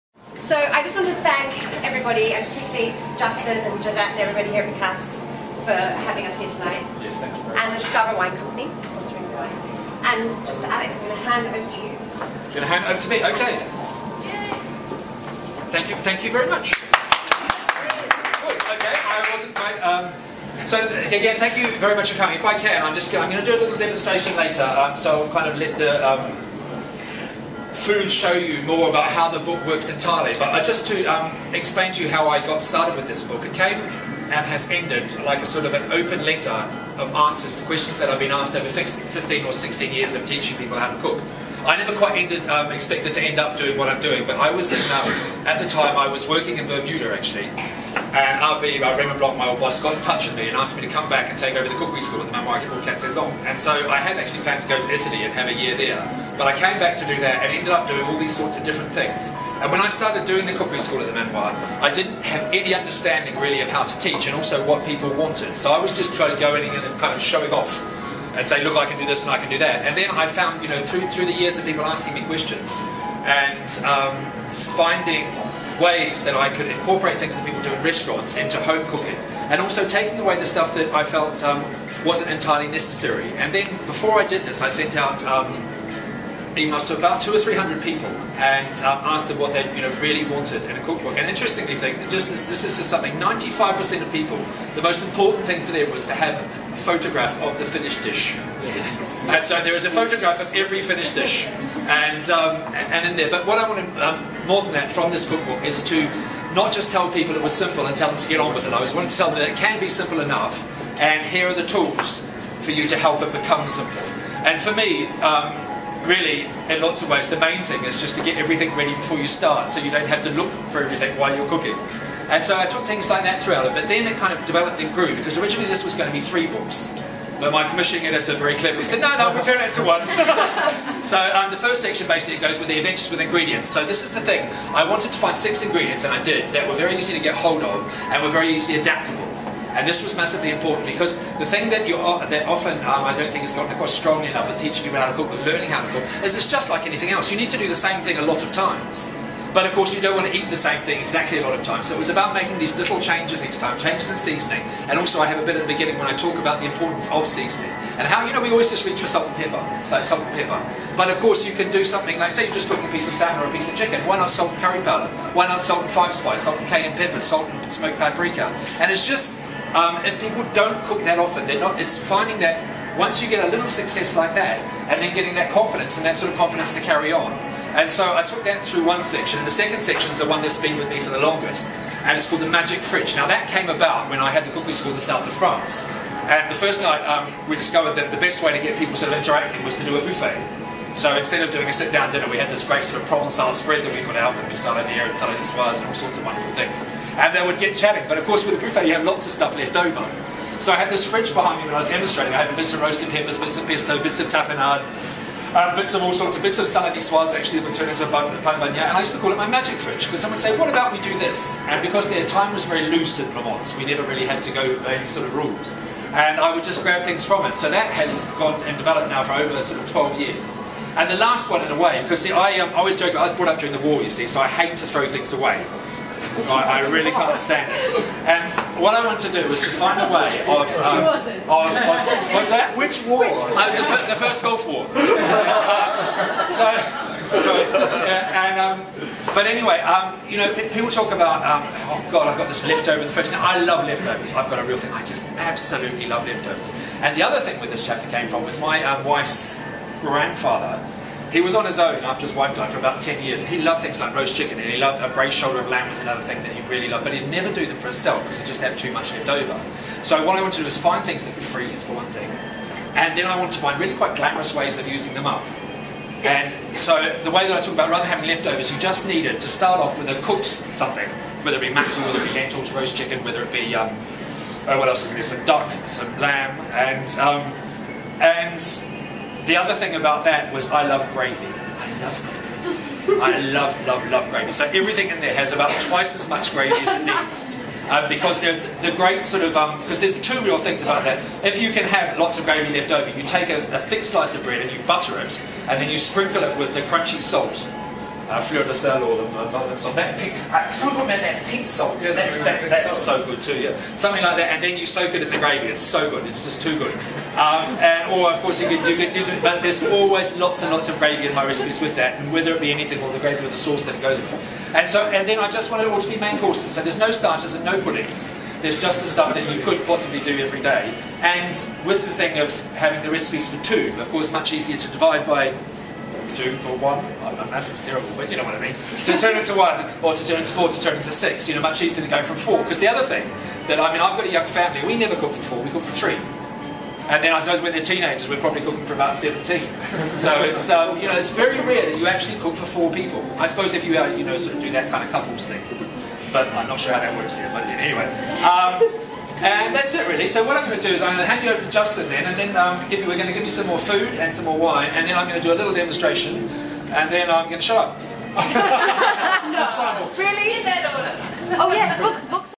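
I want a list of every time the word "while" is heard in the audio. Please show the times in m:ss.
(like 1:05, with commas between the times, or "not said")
2:01.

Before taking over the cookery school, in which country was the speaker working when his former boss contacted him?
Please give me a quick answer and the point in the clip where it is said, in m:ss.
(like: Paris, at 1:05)
Bermuda, at 0:46.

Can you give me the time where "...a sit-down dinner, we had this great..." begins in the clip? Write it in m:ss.
3:11.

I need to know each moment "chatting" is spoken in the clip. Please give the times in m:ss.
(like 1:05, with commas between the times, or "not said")
3:17.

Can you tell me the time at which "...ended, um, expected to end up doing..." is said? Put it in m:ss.
0:42.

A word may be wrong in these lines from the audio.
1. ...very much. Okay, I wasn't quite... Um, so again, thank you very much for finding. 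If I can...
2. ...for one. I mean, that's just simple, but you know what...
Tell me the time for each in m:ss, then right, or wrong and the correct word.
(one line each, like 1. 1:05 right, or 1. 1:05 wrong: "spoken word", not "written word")
1. 0:16 wrong: "coming", not "finding"
2. 5:26 wrong: "terrible", not "simple".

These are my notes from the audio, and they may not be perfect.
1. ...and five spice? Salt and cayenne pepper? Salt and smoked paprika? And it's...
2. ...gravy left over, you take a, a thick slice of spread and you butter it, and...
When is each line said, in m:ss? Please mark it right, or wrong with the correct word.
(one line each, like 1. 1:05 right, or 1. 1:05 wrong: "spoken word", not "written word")
1. 2:45 right
2. 4:52 wrong: "bread", not "spread".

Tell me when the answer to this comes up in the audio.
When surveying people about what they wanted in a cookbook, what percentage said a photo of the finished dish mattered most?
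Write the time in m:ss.
1:33.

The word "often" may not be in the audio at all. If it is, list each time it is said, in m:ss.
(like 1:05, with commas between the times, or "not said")
2:22, 2:51.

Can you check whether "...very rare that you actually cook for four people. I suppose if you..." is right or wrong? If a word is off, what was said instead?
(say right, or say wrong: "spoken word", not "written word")
right.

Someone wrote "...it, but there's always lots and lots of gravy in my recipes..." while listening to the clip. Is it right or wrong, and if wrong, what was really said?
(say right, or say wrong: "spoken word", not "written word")
right.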